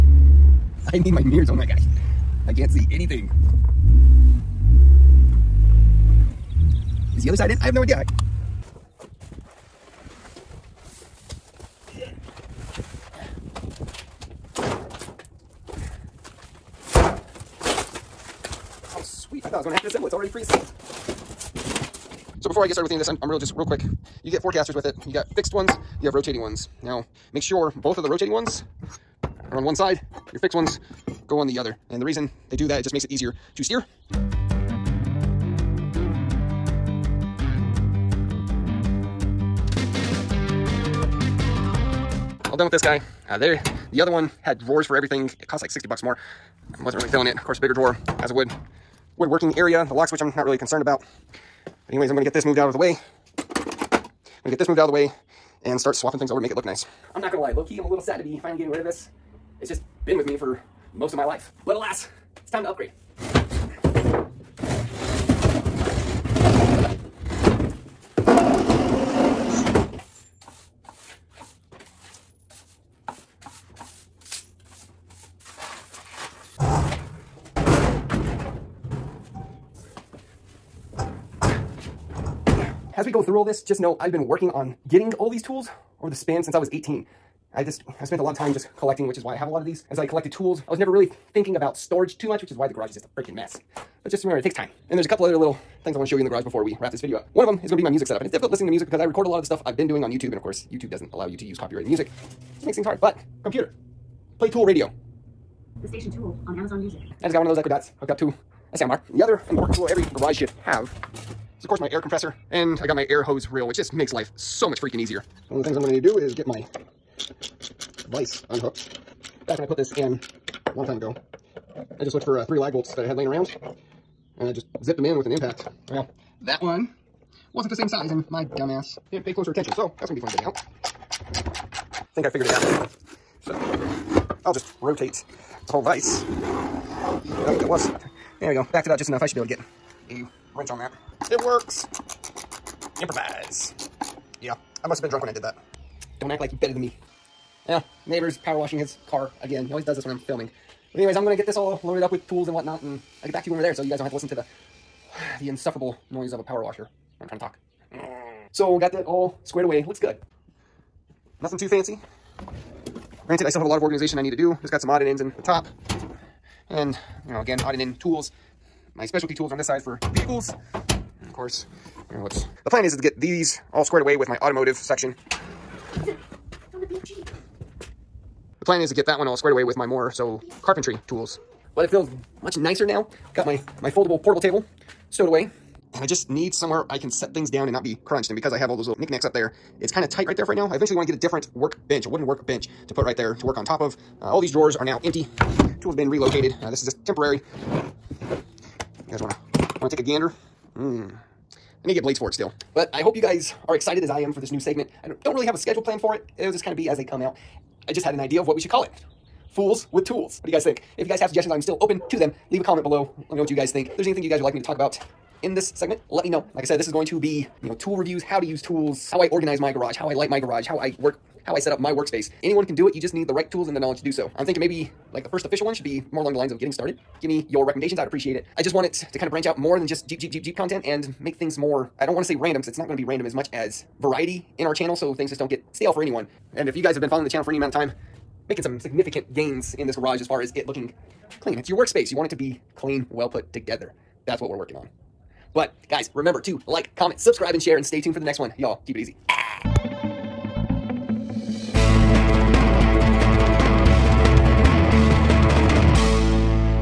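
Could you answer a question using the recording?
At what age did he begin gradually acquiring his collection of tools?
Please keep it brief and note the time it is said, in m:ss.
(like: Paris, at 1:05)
18, at 1:26.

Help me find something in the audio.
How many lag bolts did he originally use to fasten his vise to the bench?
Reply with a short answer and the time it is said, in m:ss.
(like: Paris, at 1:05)
3, at 2:02.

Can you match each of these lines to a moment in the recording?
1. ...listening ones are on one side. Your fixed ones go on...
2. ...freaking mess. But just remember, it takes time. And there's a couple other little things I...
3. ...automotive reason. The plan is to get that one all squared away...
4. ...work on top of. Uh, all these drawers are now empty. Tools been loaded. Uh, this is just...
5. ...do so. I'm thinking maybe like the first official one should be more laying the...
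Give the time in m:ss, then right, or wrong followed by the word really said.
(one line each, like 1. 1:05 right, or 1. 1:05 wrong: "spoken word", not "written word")
1. 0:28 wrong: "rotating", not "listening"
2. 1:33 right
3. 2:54 wrong: "section", not "reason"
4. 3:13 wrong: "relocated", not "loaded"
5. 3:44 wrong: "along", not "laying".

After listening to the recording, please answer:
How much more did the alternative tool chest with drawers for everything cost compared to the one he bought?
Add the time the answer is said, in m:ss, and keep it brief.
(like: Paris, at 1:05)
$60, at 0:45.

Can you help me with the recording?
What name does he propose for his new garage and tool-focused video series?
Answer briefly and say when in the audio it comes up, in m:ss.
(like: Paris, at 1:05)
Fools with Tools, at 3:29.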